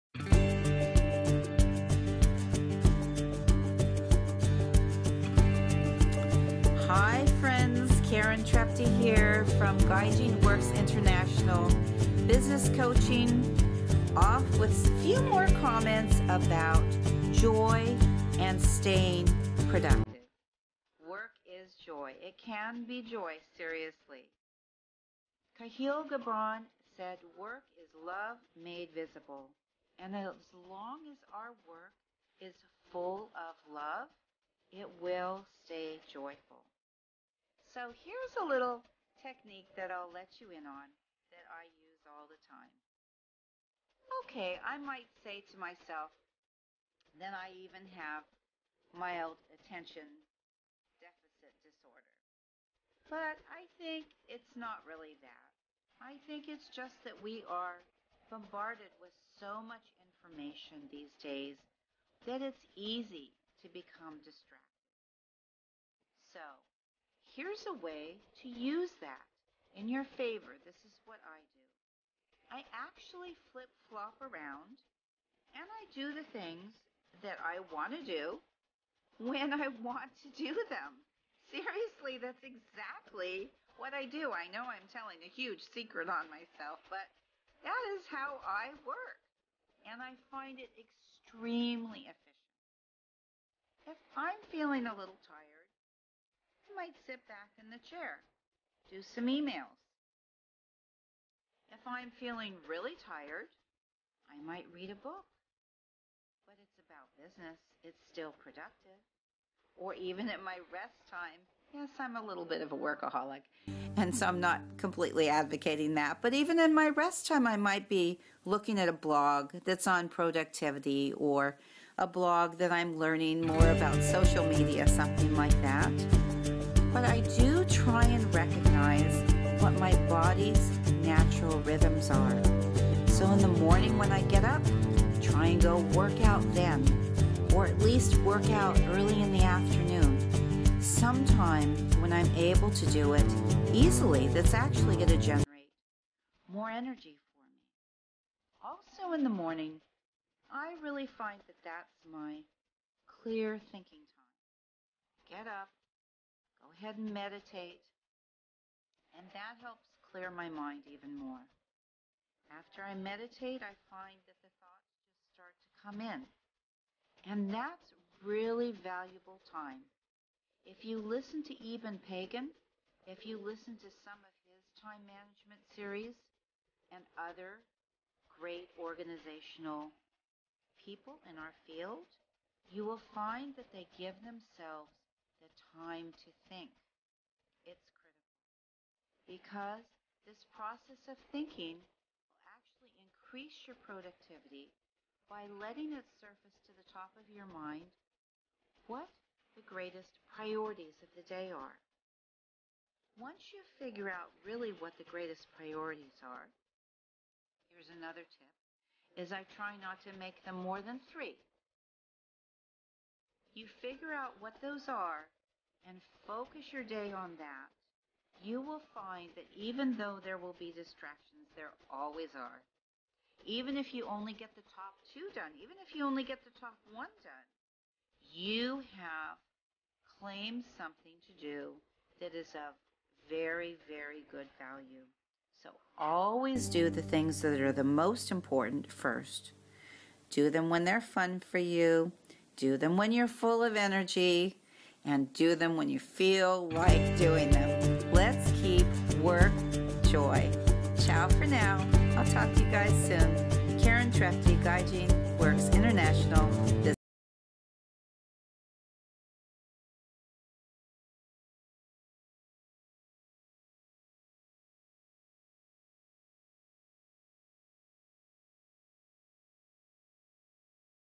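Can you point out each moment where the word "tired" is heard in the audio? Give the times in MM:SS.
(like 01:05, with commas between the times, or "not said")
01:35, 01:43.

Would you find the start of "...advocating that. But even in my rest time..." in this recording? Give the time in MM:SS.
01:55.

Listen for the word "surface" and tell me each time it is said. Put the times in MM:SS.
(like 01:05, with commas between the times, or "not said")
03:16.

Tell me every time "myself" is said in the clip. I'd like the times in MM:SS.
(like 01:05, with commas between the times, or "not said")
00:45, 01:26.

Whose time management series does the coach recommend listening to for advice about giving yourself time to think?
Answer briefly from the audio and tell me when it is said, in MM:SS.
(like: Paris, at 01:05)
Eben Pagan, at 02:51.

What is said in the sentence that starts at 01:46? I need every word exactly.
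But it's about business, it's still productive.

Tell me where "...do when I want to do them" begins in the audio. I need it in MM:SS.
01:18.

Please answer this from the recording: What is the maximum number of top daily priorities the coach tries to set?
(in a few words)
3.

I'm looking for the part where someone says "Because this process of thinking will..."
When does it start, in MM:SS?
03:09.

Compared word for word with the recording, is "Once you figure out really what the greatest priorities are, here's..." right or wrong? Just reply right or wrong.
right.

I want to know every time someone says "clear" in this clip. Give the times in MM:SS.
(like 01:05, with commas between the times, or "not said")
02:33, 02:40.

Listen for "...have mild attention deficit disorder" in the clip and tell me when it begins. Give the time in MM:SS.
00:47.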